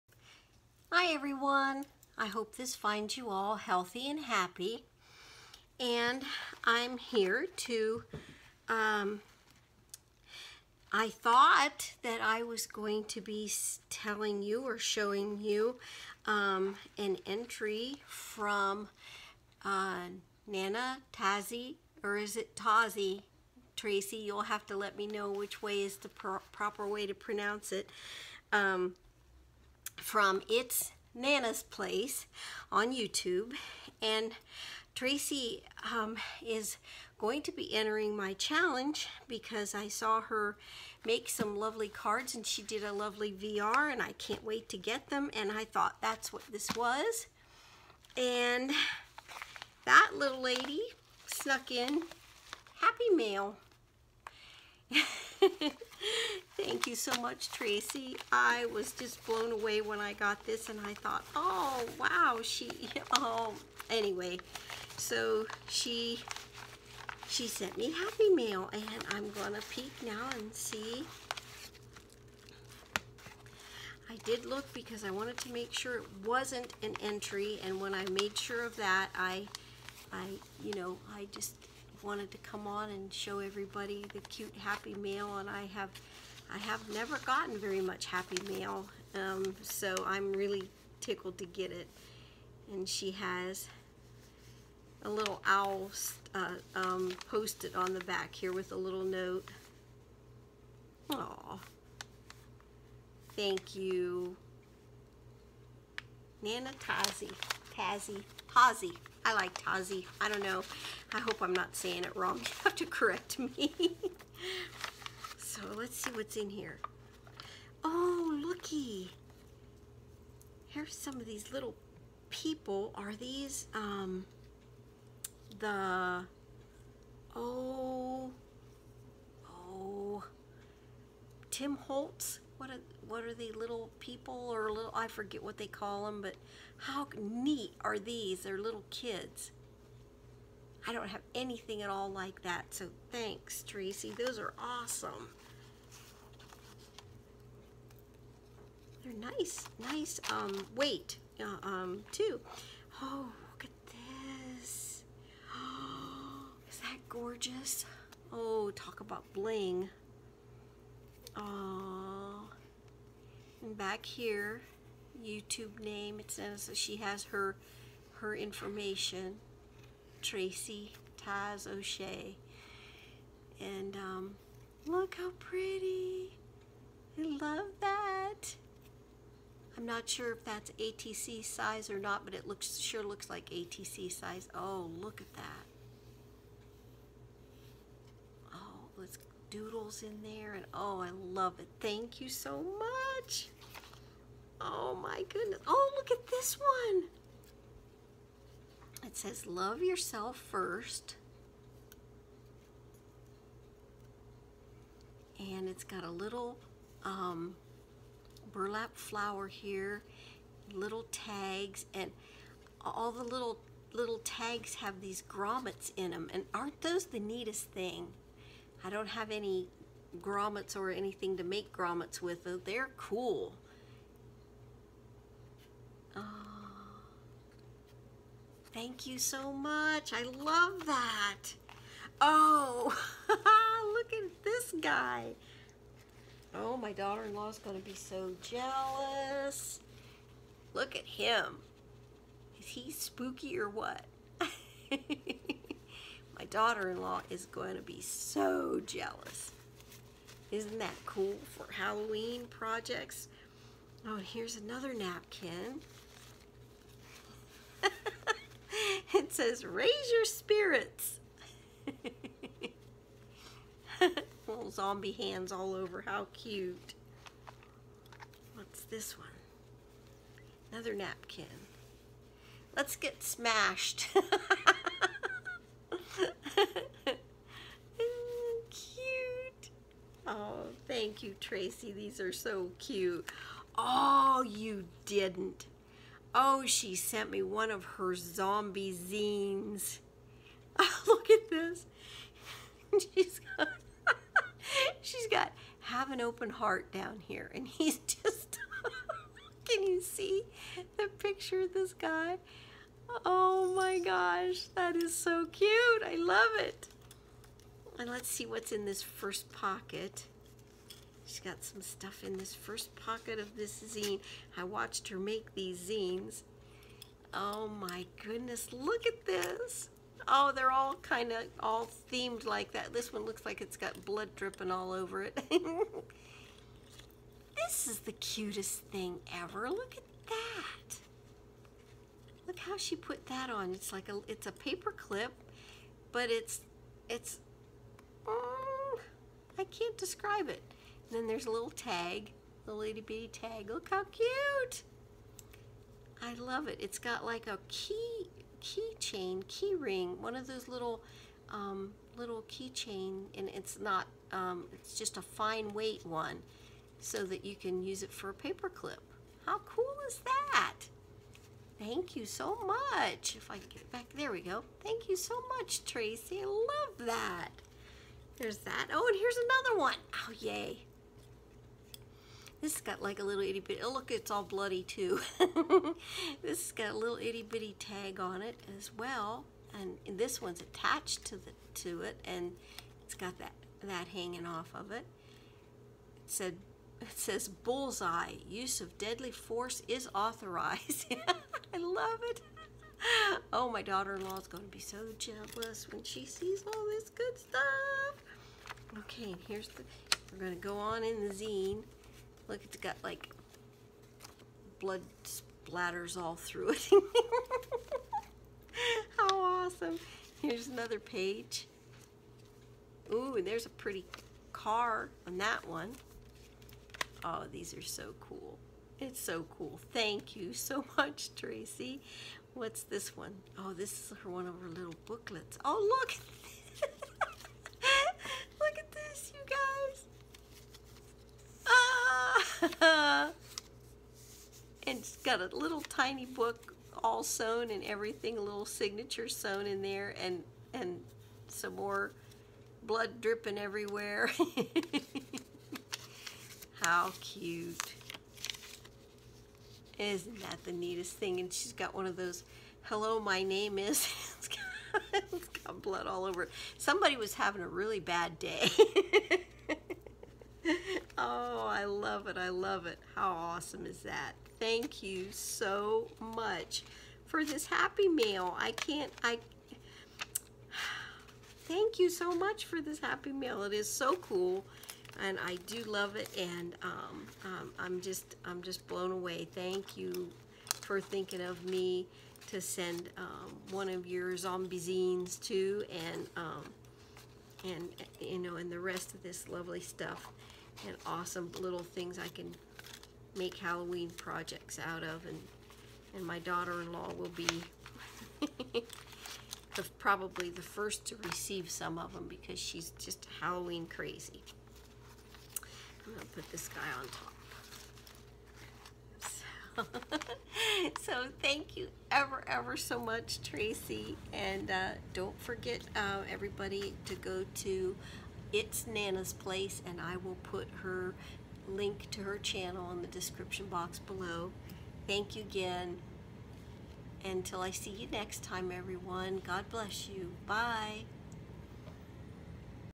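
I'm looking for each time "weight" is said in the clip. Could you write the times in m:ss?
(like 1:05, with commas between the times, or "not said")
2:30, 5:55.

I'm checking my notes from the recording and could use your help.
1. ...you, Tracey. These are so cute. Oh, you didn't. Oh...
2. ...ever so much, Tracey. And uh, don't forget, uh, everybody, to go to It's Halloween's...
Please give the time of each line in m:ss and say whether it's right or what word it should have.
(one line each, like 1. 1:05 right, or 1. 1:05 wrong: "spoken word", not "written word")
1. 4:41 right
2. 8:32 wrong: "Nanna", not "Halloween".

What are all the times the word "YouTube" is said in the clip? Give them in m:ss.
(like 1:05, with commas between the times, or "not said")
0:32, 2:45.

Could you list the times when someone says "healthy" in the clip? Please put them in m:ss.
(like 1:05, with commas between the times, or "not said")
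0:03.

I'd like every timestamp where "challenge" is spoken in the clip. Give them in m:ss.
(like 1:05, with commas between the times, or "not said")
0:38.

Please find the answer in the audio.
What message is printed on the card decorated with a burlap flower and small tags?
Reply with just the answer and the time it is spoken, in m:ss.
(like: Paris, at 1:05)
Love yourself first, at 3:19.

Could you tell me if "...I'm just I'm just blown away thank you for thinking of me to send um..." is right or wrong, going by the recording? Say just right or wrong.
right.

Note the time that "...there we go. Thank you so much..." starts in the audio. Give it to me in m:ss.
6:04.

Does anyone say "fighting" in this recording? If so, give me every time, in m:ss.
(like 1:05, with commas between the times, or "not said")
not said.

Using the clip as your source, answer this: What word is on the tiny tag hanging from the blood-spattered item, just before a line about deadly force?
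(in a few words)
Bullseye.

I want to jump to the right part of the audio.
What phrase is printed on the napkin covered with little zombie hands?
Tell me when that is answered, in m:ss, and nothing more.
4:19.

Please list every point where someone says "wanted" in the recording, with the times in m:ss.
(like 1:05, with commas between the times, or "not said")
1:15, 1:22.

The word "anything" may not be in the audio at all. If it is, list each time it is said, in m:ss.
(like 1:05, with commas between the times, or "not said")
2:21, 3:40.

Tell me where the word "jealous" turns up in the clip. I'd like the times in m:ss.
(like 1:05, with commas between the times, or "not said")
3:58, 4:08, 6:35.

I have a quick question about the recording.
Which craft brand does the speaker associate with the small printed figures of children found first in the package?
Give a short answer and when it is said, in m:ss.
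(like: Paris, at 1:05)
Tim Holtz, at 2:11.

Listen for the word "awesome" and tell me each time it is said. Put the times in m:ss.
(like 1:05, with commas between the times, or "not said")
2:24, 6:49, 7:43, 8:11.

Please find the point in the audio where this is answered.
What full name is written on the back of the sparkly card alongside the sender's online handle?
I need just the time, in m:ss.
2:50.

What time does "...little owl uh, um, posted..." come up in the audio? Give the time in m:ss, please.
1:35.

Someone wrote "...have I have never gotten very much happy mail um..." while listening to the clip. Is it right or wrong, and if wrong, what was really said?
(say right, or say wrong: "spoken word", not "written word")
right.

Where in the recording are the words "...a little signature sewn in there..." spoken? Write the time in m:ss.
7:18.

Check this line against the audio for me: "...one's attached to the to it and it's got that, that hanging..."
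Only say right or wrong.
right.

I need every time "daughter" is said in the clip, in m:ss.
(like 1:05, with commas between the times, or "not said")
3:56, 4:06, 6:33, 8:16.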